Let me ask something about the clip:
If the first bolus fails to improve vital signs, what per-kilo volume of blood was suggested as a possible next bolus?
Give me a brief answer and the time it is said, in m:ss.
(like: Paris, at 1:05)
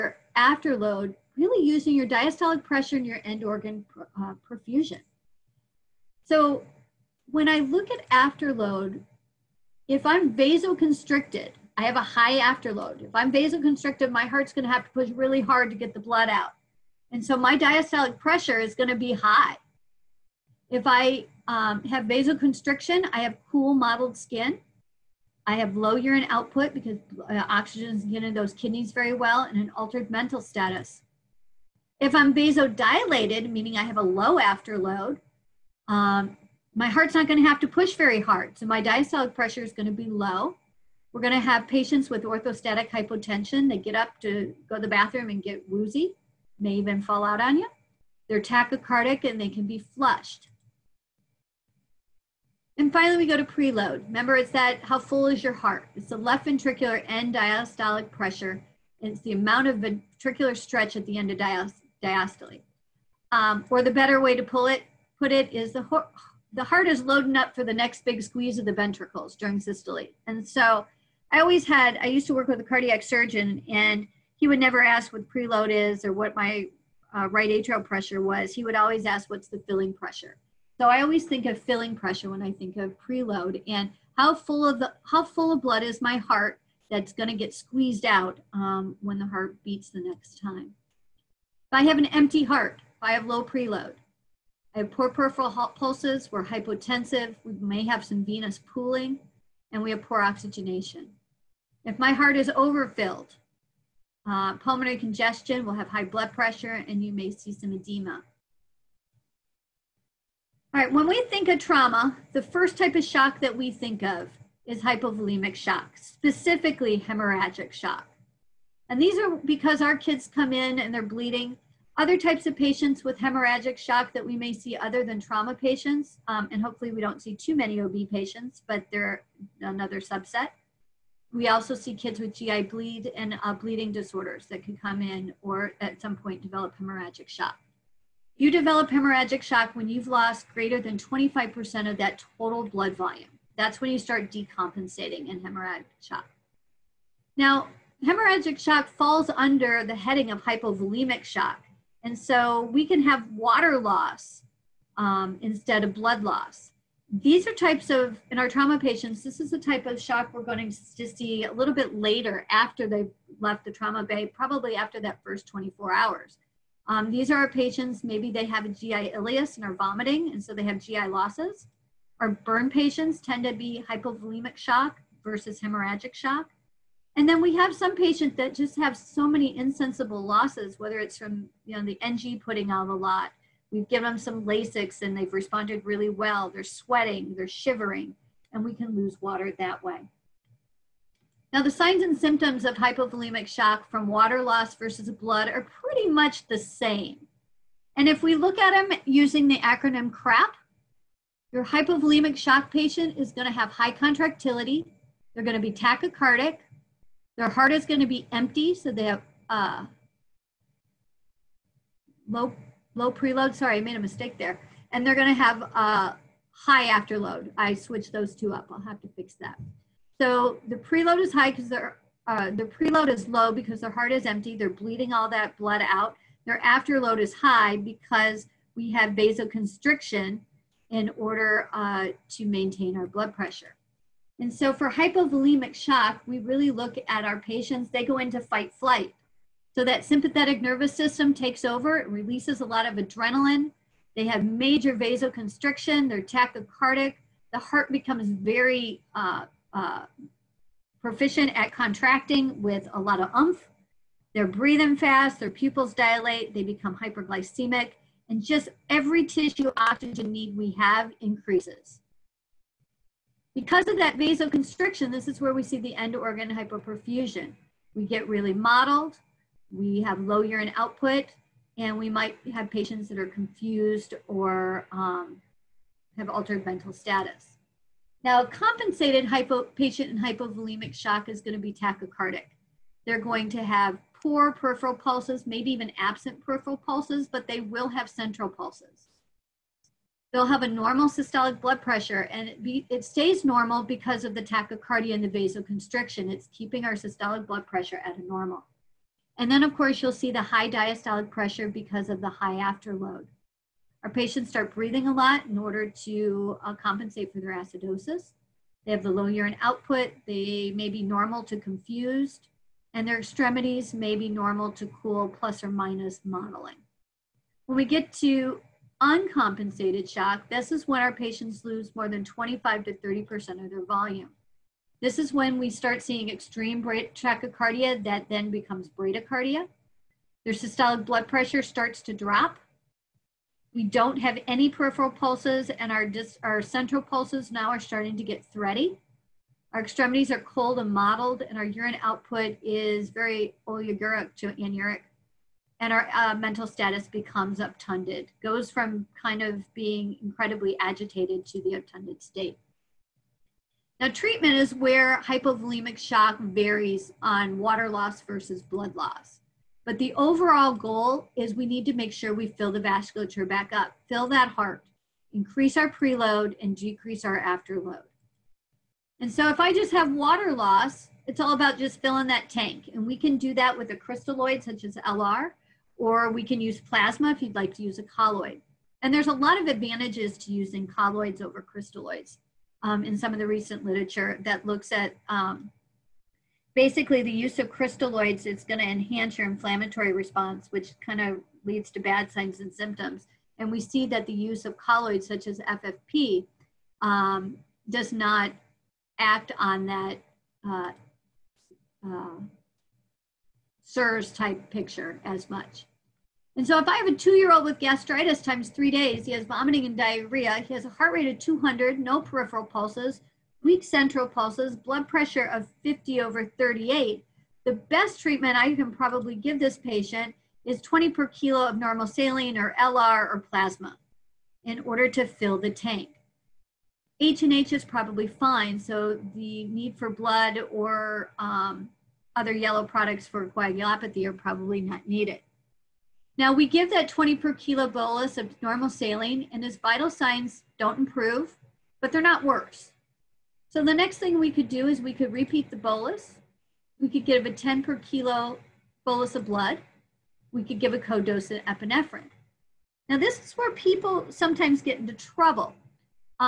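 10 per kilo, at 7:27.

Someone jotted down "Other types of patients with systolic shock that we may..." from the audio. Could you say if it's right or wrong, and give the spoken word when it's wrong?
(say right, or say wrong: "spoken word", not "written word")
wrong: "hemorrhagic", not "systolic".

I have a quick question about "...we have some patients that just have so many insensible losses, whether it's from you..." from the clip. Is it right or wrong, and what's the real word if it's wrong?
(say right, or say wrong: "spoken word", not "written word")
right.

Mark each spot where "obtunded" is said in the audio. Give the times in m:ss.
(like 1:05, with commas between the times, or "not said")
5:47, 5:51.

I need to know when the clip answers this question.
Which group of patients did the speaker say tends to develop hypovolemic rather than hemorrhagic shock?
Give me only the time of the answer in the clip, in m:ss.
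2:52.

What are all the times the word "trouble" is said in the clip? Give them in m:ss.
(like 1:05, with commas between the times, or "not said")
7:35.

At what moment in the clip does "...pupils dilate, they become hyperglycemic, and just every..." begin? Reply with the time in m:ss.
4:15.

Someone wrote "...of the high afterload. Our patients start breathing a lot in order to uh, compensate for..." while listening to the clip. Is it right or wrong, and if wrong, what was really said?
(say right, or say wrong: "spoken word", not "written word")
right.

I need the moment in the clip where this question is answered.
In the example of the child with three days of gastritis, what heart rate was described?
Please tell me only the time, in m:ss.
6:50.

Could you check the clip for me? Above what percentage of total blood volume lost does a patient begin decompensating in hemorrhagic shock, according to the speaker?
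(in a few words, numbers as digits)
25%.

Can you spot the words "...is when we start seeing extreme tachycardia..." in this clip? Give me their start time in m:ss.
5:25.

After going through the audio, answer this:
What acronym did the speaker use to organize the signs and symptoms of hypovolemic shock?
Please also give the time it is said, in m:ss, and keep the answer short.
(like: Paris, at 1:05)
CRAP, at 3:20.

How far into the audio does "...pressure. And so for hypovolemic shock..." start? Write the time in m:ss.
3:53.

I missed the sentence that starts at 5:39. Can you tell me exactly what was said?
Our extremities are cold and mottled and our urine output is very oliguric to anuric.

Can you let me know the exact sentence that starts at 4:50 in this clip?
They'll have a normal systolic blood pressure, and it, be, it stays normal because of the tachycardia and the vasoconstriction.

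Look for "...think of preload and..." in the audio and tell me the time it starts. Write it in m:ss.
1:22.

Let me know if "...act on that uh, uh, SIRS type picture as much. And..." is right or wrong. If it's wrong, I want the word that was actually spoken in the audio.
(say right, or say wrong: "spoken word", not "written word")
right.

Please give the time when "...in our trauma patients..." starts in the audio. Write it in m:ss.
2:38.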